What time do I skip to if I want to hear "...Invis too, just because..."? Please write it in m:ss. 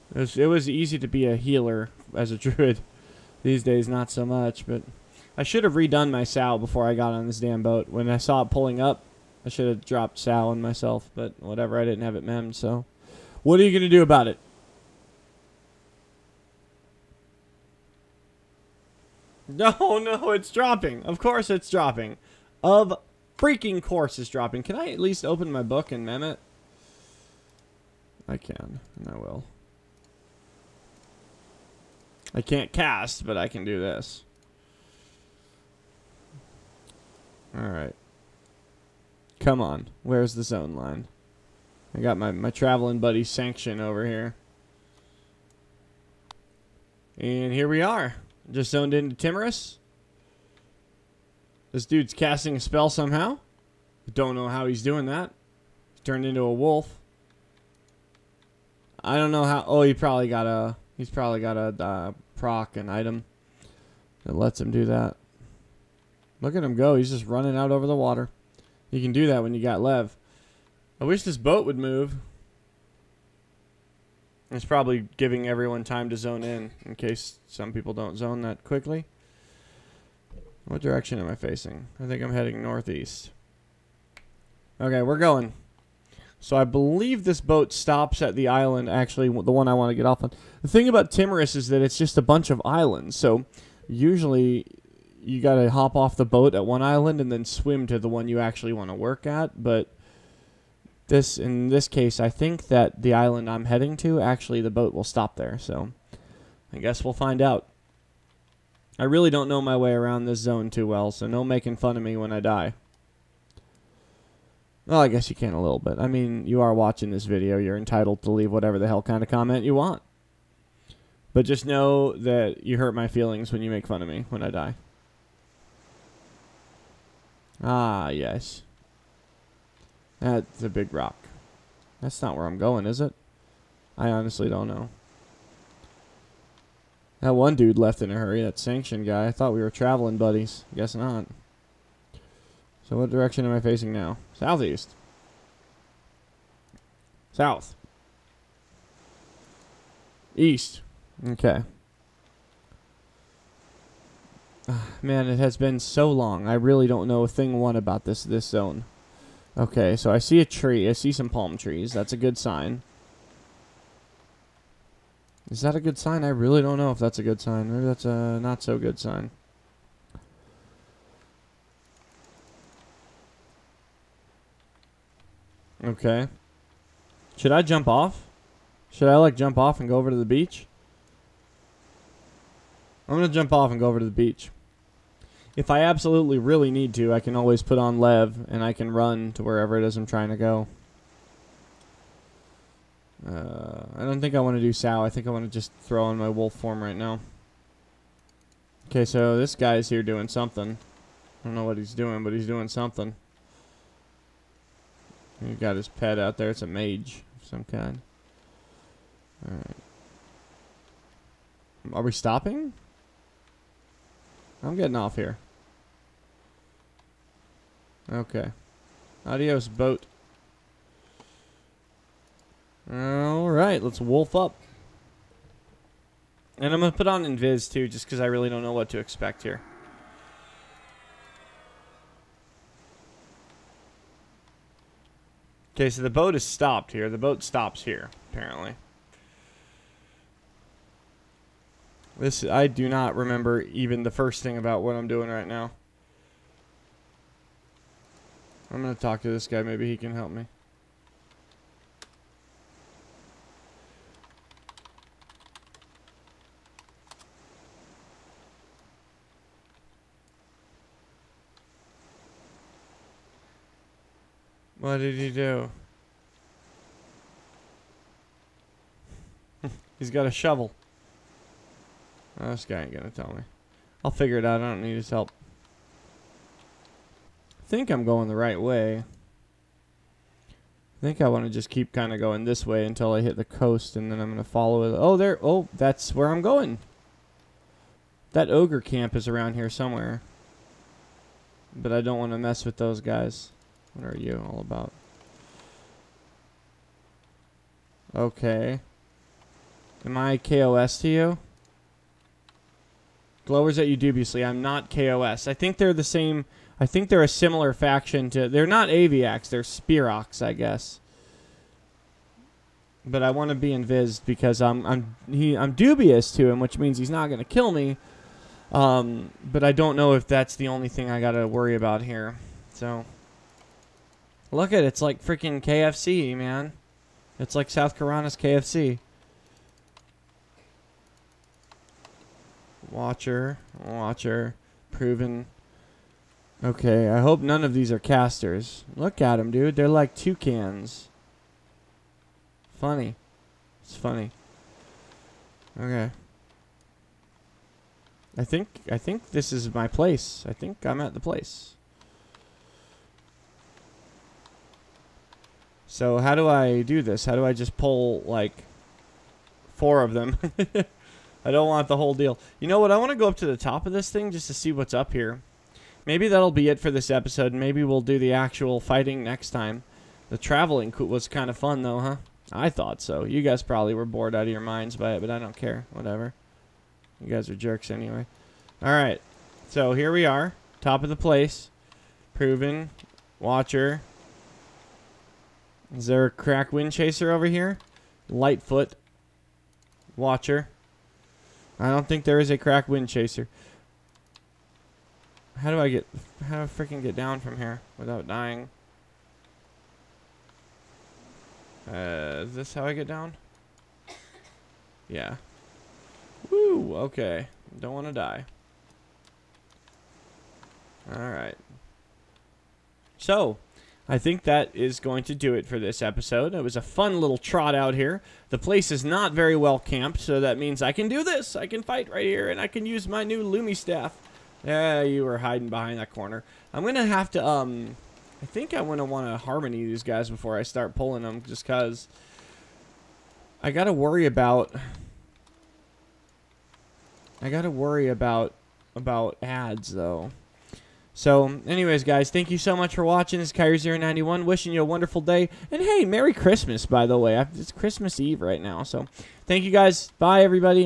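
3:47.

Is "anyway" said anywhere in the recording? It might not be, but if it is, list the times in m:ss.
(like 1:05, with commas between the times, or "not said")
6:17, 7:21.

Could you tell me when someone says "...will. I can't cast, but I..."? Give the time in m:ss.
0:29.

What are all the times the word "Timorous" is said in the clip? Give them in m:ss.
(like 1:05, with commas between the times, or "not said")
0:49, 1:31.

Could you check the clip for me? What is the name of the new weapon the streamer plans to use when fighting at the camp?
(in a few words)
Lumi staff.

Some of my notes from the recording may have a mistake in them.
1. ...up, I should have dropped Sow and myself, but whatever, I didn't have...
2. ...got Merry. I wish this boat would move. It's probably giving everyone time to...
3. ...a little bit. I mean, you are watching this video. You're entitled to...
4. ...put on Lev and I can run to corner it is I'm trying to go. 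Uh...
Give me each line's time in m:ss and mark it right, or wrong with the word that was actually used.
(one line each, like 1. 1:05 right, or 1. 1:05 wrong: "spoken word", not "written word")
1. 0:08 right
2. 1:09 wrong: "Lev", not "Merry"
3. 1:55 right
4. 3:07 wrong: "wherever", not "corner".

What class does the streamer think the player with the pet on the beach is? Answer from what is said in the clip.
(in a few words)
Mage.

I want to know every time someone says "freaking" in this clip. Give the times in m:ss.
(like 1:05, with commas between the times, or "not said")
0:23, 5:25, 6:36.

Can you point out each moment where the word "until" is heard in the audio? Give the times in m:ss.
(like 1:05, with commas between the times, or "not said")
4:42.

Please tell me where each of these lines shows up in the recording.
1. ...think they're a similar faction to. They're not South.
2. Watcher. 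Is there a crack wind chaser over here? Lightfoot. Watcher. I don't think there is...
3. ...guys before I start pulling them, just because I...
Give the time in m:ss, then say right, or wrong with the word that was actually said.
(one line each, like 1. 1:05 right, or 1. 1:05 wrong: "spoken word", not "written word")
1. 5:06 wrong: "Aviax", not "South"
2. 6:23 right
3. 7:10 right.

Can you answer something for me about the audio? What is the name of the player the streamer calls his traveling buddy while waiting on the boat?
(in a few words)
Sanction.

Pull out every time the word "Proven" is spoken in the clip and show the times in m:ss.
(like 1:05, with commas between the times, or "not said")
5:34, 6:22.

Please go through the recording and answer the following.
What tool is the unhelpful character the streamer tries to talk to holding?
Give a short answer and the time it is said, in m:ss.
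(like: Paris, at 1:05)
A shovel, at 4:30.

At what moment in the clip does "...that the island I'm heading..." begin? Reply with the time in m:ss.
1:42.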